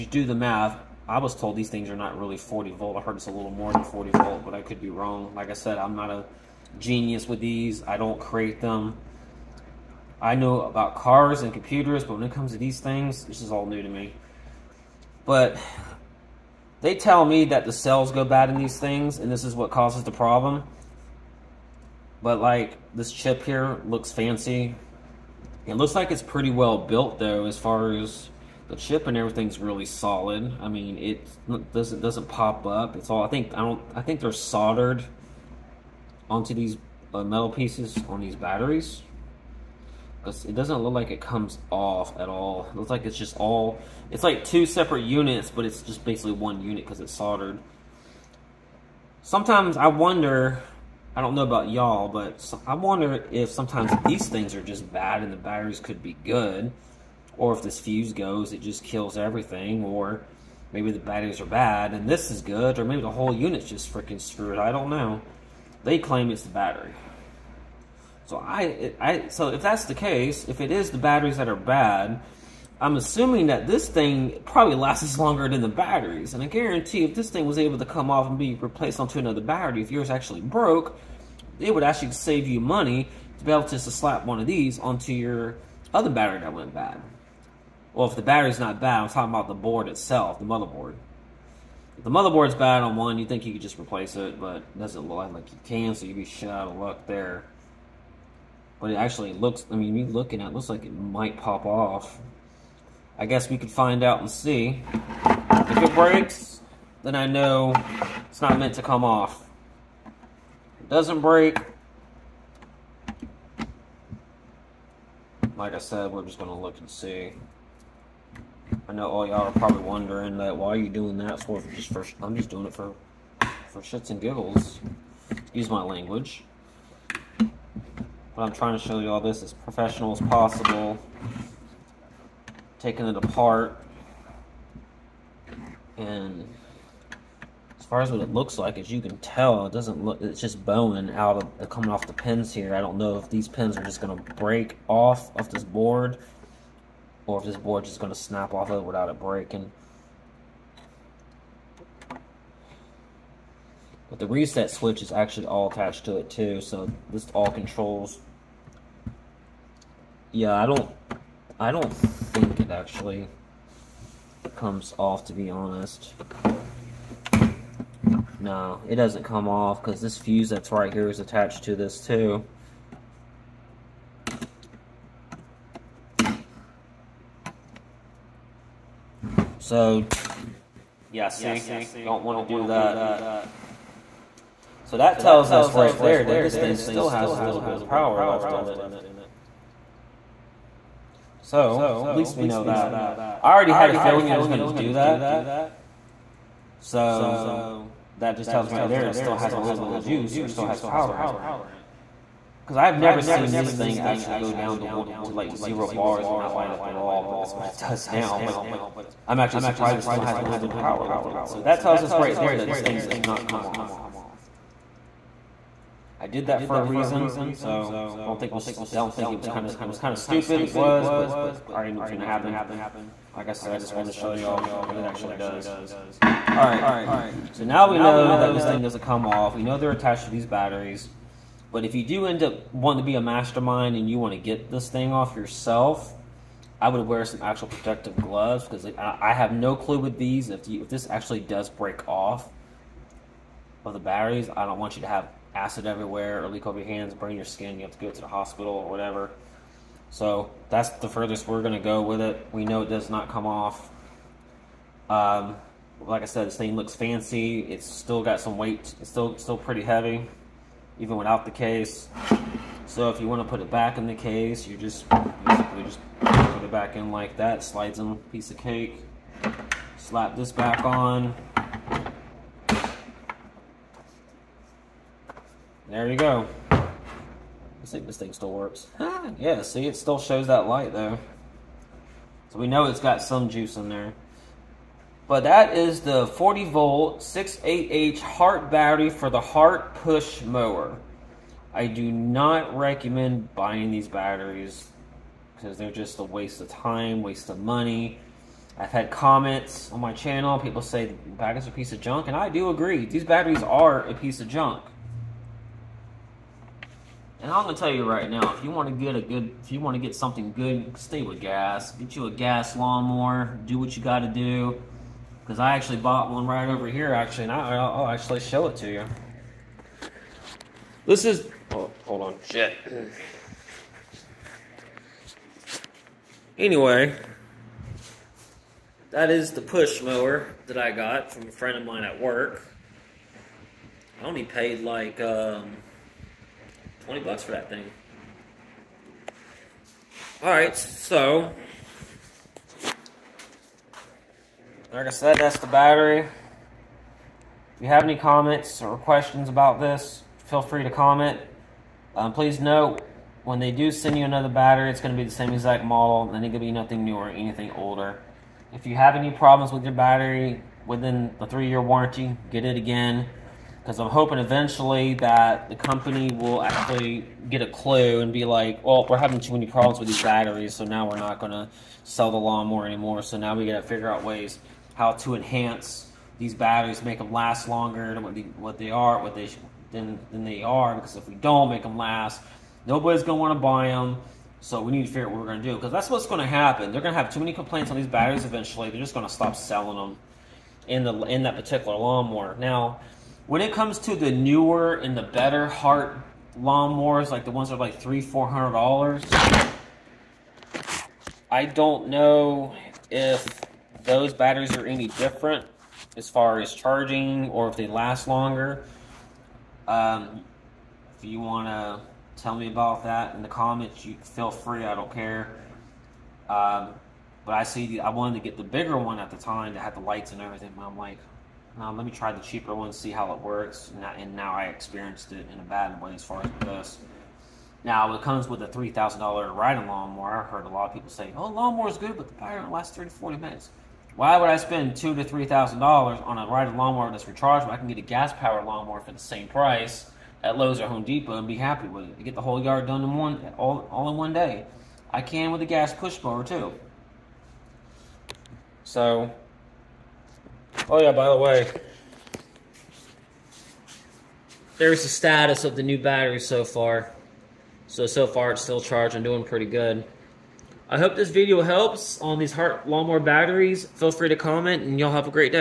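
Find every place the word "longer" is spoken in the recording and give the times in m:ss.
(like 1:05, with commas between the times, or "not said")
1:15, 6:17, 6:48.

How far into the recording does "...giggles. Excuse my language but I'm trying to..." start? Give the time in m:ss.
2:04.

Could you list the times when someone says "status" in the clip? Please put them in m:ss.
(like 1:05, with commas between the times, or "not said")
7:35.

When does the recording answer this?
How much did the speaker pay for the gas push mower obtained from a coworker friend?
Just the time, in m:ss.
5:37.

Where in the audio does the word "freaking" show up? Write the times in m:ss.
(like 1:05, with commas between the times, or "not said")
1:03.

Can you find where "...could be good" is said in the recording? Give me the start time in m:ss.
0:55.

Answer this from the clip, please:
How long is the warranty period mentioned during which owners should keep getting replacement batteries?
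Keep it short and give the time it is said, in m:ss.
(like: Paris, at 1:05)
3 years, at 6:01.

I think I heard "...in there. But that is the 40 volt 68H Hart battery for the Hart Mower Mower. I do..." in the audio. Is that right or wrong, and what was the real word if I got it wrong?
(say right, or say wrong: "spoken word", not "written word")
wrong: "Push", not "Mower".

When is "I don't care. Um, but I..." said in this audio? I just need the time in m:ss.
6:54.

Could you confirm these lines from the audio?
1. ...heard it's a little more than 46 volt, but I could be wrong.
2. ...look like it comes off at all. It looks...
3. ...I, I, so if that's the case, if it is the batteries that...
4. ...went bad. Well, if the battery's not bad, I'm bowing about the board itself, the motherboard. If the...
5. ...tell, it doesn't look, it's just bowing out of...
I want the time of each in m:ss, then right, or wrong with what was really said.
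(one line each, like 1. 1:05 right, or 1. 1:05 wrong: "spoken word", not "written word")
1. 0:03 wrong: "40", not "46"
2. 0:40 right
3. 1:08 right
4. 1:26 wrong: "talking", not "bowing"
5. 2:19 right.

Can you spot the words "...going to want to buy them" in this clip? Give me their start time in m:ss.
6:23.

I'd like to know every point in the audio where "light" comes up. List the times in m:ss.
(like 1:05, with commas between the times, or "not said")
3:26, 4:40, 7:00.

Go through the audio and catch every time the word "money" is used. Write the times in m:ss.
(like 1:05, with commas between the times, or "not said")
1:22, 4:57.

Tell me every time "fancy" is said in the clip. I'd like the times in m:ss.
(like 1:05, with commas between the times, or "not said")
0:24, 4:16.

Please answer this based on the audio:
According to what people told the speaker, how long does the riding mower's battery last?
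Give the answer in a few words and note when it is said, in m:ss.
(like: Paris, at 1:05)
30 to 40 minutes, at 7:12.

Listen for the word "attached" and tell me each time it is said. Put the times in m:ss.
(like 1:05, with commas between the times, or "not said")
2:35, 2:51, 3:49.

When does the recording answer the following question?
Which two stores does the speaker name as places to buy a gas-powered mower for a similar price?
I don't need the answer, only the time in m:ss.
7:20.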